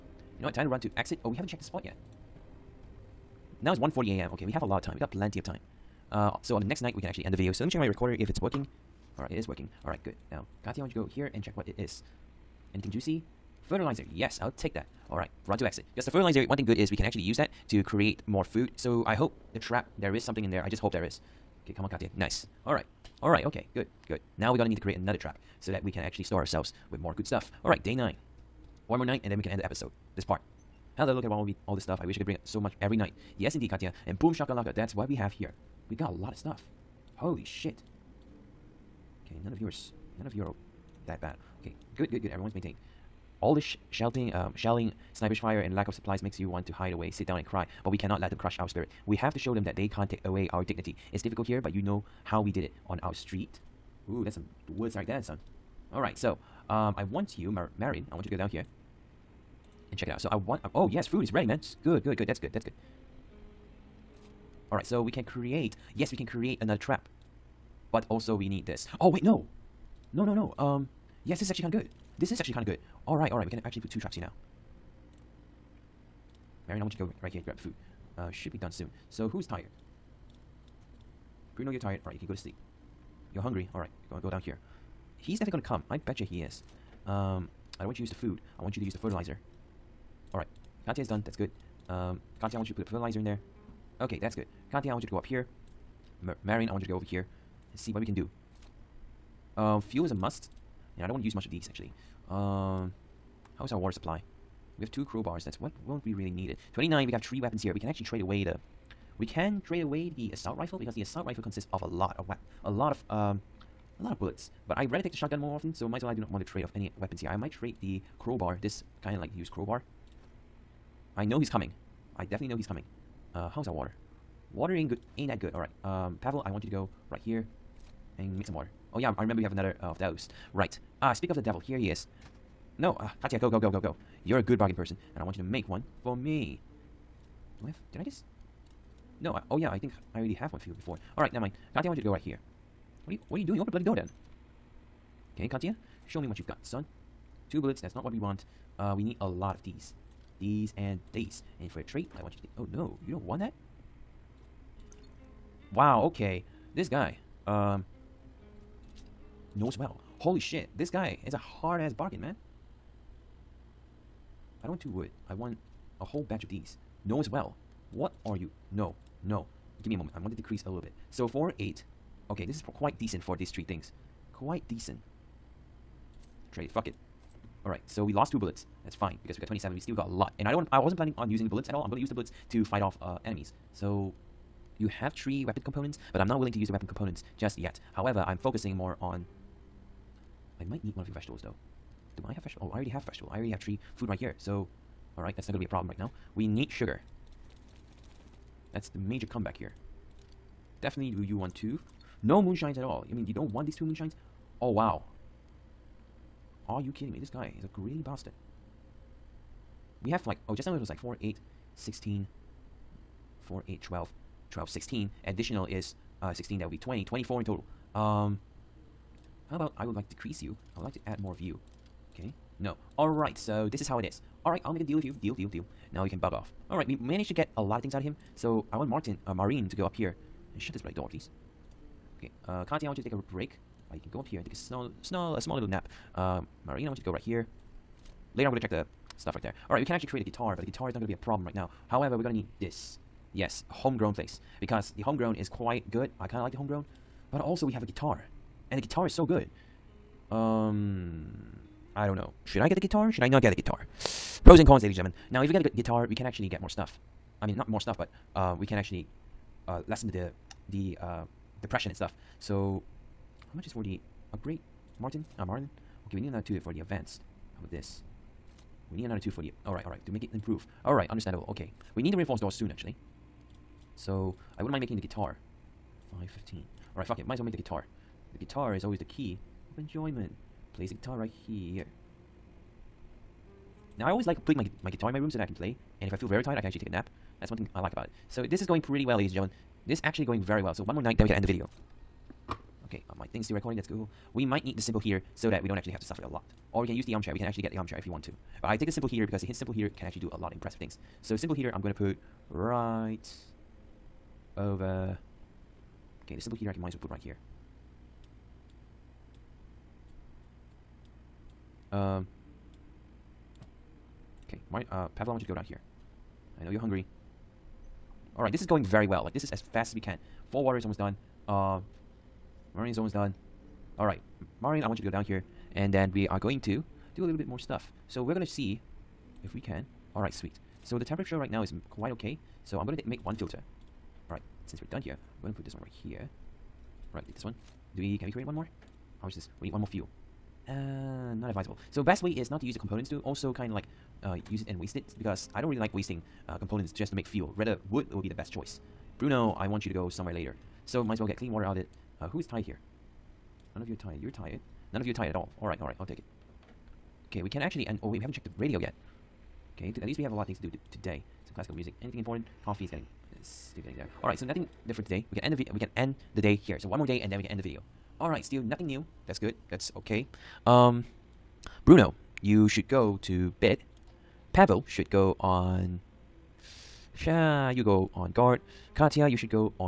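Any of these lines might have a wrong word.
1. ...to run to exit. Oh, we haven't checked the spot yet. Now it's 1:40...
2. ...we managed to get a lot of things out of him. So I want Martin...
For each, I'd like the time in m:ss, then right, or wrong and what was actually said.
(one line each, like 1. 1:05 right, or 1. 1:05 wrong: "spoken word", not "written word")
1. 0:00 right
2. 3:46 right.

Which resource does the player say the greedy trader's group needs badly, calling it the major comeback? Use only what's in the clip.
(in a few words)
Sugar.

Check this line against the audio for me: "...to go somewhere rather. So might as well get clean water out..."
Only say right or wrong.
wrong.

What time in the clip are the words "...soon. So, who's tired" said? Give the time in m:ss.
1:18.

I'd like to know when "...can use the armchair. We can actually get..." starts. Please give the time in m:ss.
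4:56.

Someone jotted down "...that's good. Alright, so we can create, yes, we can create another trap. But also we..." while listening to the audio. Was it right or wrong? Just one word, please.
right.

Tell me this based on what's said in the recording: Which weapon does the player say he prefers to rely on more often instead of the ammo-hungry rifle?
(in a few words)
Shotgun.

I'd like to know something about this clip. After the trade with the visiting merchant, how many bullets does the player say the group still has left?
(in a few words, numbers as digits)
27.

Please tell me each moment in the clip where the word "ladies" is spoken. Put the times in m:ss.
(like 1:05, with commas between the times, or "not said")
4:14, 4:49.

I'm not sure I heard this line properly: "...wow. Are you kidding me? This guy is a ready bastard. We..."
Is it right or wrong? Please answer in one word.
wrong.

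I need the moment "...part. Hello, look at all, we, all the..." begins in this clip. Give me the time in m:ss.
0:30.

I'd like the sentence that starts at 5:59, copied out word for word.
Okay, at least we have a lot of things to do to today.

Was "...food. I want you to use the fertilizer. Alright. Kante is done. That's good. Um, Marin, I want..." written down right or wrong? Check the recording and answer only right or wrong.
wrong.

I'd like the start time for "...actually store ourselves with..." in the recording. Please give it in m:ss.
0:26.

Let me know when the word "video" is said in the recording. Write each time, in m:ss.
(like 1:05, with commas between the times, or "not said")
0:07, 4:51, 6:07.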